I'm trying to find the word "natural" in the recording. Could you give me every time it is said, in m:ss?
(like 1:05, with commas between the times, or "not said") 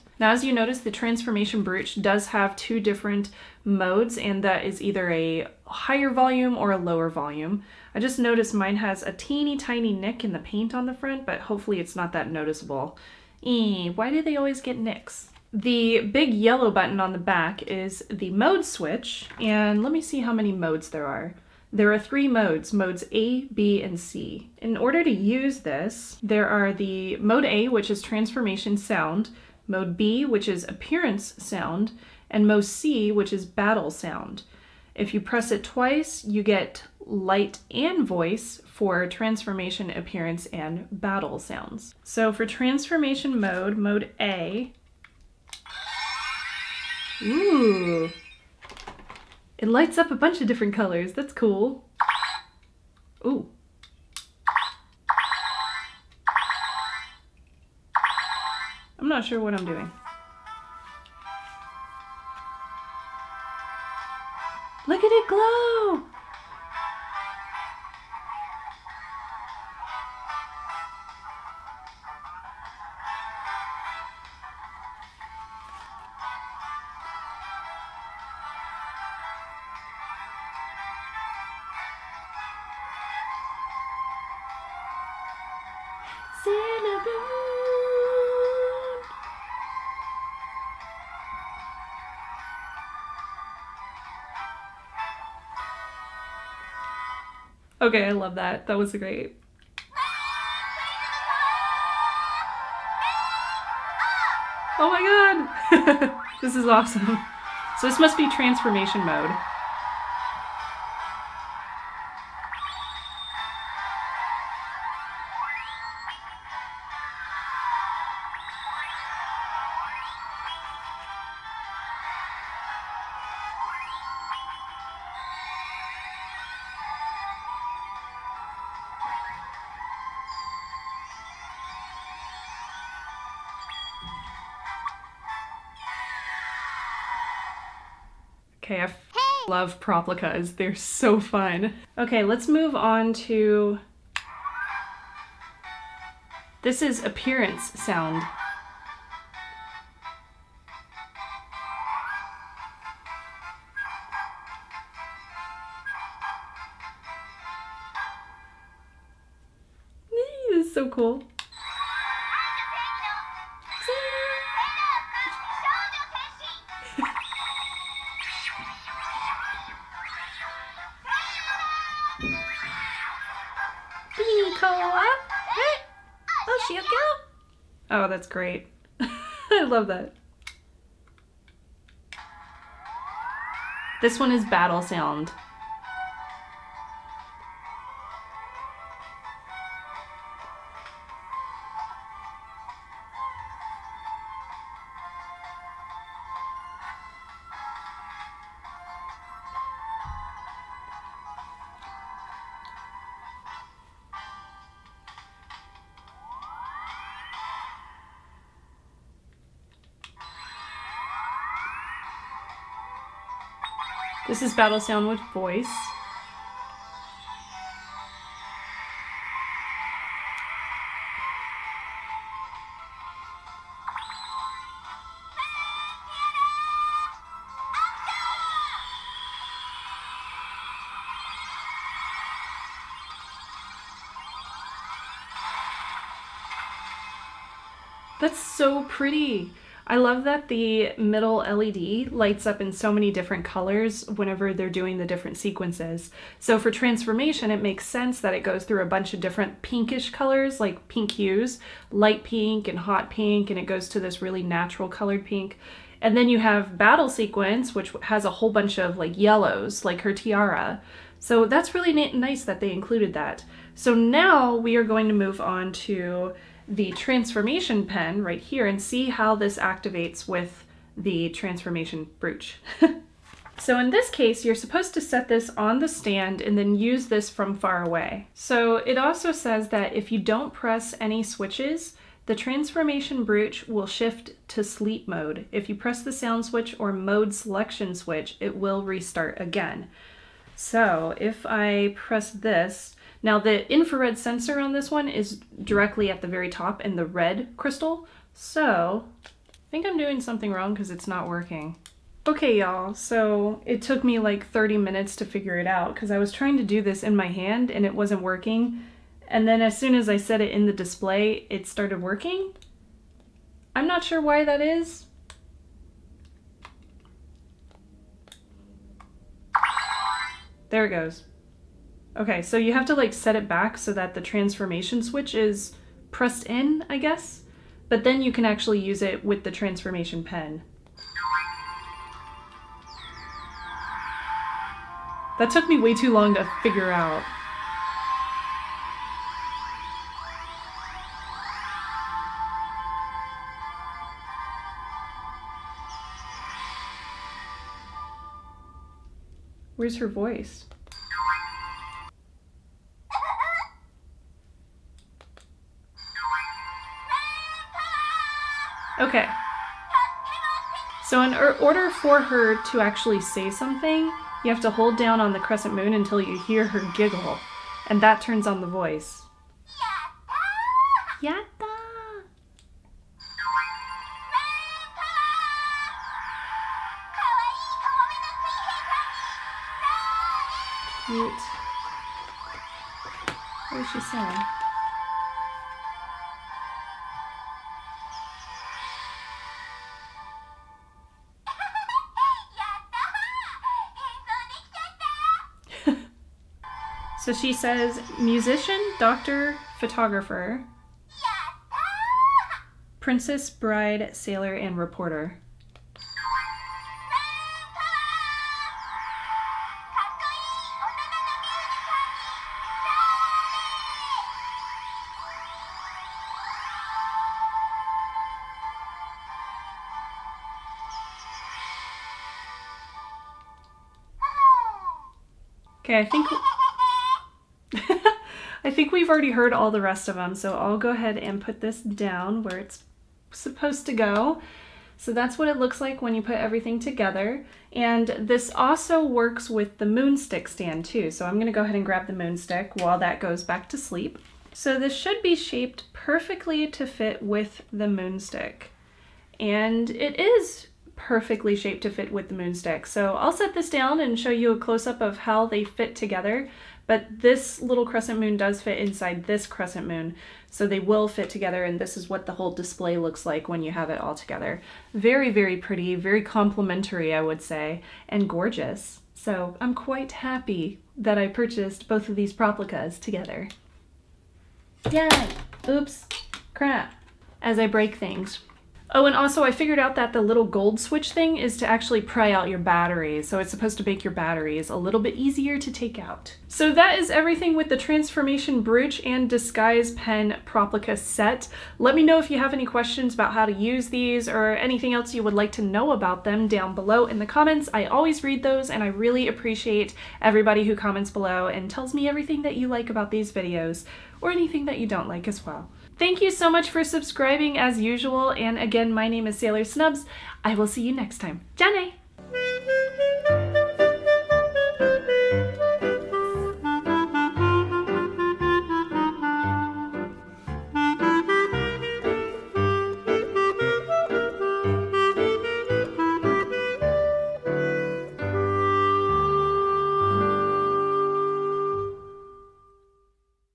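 4:14.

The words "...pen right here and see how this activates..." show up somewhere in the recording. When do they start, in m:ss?
4:27.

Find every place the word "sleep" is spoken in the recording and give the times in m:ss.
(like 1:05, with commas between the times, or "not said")
4:44, 7:23.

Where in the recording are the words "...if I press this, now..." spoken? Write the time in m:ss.
4:51.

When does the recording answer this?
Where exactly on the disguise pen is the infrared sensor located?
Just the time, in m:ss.
4:57.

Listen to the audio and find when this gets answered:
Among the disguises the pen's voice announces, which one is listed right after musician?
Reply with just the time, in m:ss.
6:38.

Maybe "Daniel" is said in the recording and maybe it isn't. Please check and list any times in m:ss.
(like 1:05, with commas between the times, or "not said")
not said.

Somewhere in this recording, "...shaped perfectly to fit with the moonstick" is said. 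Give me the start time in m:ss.
7:25.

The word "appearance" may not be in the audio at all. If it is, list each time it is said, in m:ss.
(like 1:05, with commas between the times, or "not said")
0:30, 0:39, 2:27.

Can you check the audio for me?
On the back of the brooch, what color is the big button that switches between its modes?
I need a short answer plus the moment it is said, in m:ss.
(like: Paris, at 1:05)
yellow, at 0:16.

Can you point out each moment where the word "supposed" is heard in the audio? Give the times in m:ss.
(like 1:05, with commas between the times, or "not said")
4:34, 7:13, 8:03.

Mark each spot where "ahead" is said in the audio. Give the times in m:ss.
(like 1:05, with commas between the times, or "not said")
7:10, 7:21.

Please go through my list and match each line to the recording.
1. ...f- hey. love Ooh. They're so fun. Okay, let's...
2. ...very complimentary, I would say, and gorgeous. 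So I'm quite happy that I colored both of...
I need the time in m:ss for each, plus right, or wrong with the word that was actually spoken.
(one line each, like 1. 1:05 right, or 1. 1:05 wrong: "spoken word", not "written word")
1. 2:18 wrong: "Proplicas", not "Ooh"
2. 7:45 wrong: "purchased", not "colored".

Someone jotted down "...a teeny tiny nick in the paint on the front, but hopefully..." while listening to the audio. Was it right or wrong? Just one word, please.
right.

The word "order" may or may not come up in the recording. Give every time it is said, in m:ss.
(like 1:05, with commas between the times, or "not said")
0:24, 6:01.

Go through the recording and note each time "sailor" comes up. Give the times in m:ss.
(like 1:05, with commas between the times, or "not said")
6:44, 8:29.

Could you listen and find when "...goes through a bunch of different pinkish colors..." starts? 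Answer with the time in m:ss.
4:08.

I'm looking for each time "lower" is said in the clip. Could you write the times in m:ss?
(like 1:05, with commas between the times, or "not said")
0:06.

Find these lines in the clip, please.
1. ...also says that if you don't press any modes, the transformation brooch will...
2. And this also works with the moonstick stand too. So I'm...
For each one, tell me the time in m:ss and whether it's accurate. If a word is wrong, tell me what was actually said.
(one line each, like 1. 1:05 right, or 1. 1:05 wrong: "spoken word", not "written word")
1. 4:38 wrong: "switches", not "modes"
2. 7:17 right.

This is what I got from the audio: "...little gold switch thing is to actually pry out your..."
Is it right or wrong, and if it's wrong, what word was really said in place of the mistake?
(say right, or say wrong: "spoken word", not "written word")
right.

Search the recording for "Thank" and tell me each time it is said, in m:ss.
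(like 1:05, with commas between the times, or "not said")
8:25.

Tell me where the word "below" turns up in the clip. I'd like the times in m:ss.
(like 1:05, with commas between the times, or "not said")
8:16, 8:21.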